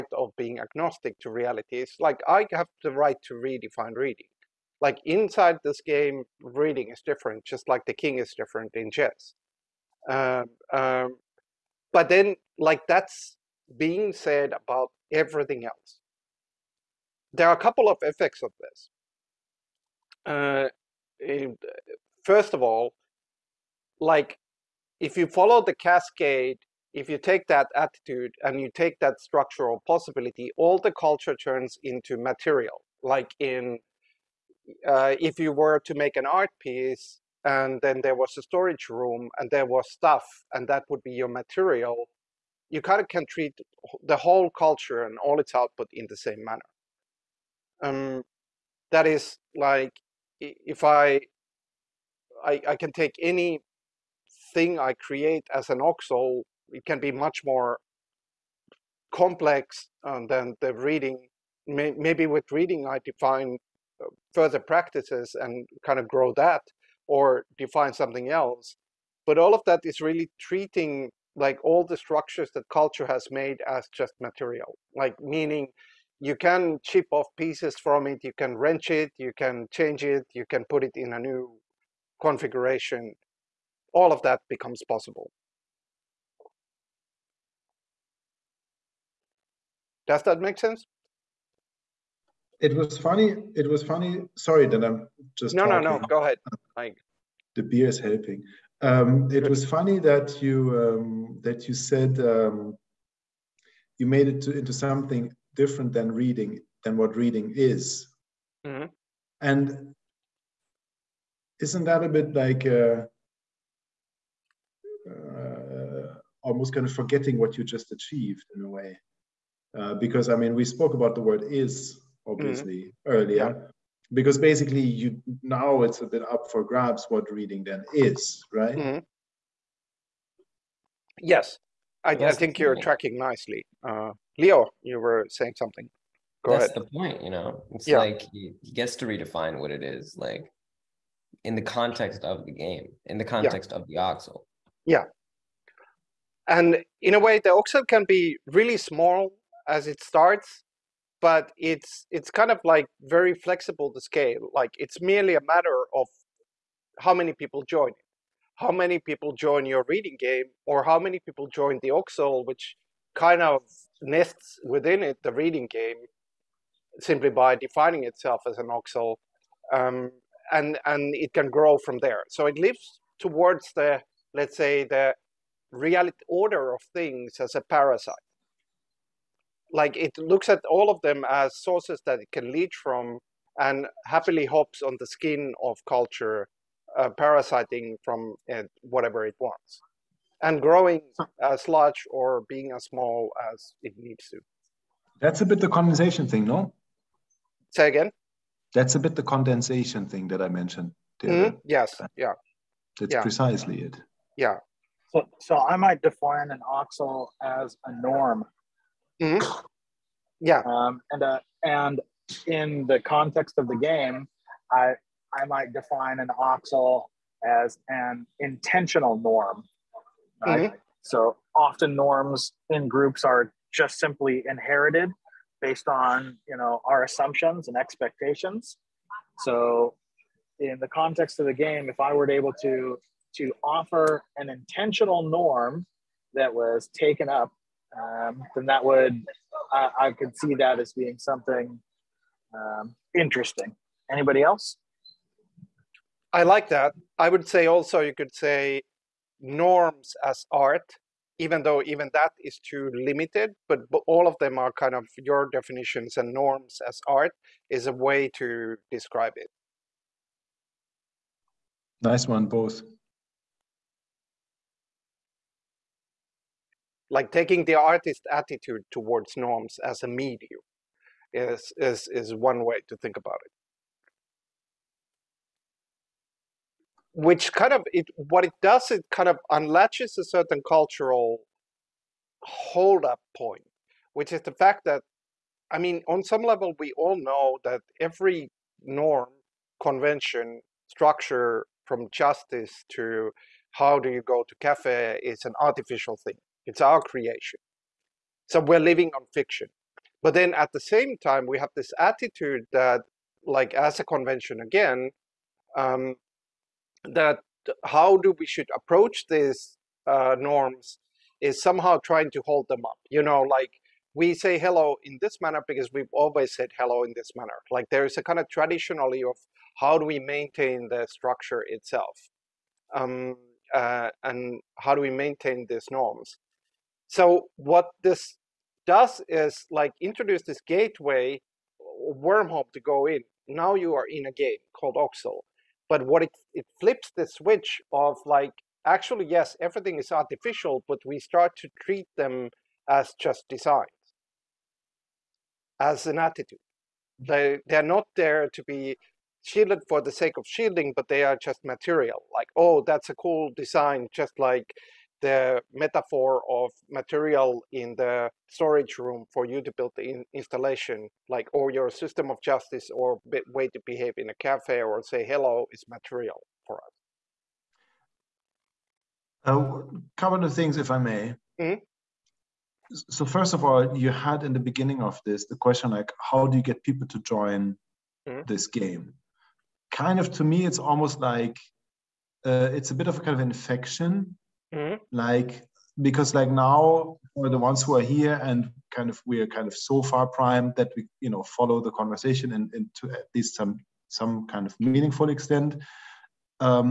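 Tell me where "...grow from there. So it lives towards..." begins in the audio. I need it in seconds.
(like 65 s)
171 s.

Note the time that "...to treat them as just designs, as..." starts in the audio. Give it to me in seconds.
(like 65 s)
341 s.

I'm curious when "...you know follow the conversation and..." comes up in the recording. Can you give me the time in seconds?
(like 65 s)
391 s.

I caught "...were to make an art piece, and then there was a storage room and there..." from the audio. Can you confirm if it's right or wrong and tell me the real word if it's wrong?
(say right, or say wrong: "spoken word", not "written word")
right.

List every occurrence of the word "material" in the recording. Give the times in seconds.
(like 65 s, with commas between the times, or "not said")
32 s, 41 s, 74 s, 351 s, 356 s, 365 s.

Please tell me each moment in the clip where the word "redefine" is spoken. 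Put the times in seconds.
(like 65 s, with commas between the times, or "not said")
3 s, 139 s.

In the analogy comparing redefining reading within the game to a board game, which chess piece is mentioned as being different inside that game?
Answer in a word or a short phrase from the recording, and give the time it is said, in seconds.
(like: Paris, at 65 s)
king, at 7 s.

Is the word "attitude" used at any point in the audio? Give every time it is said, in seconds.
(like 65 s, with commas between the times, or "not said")
27 s, 268 s, 301 s, 346 s.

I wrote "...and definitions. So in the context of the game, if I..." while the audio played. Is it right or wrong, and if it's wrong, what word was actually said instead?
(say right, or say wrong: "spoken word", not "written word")
wrong: "expectations", not "definitions".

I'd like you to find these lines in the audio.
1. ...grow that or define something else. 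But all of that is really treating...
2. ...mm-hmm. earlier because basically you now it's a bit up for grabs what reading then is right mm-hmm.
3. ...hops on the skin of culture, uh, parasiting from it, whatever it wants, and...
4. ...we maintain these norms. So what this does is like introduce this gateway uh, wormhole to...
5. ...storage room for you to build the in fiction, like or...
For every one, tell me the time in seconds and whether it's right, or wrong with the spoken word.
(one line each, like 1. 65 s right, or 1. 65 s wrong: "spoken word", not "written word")
1. 66 s right
2. 122 s right
3. 184 s right
4. 325 s right
5. 358 s wrong: "installation", not "fiction".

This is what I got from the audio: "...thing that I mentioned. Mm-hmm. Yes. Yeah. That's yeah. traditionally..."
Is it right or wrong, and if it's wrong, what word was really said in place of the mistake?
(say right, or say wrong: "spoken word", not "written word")
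wrong: "precisely", not "traditionally".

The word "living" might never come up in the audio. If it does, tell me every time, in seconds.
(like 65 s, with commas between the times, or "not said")
298 s.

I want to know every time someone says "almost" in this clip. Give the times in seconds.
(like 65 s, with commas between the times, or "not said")
116 s, 380 s.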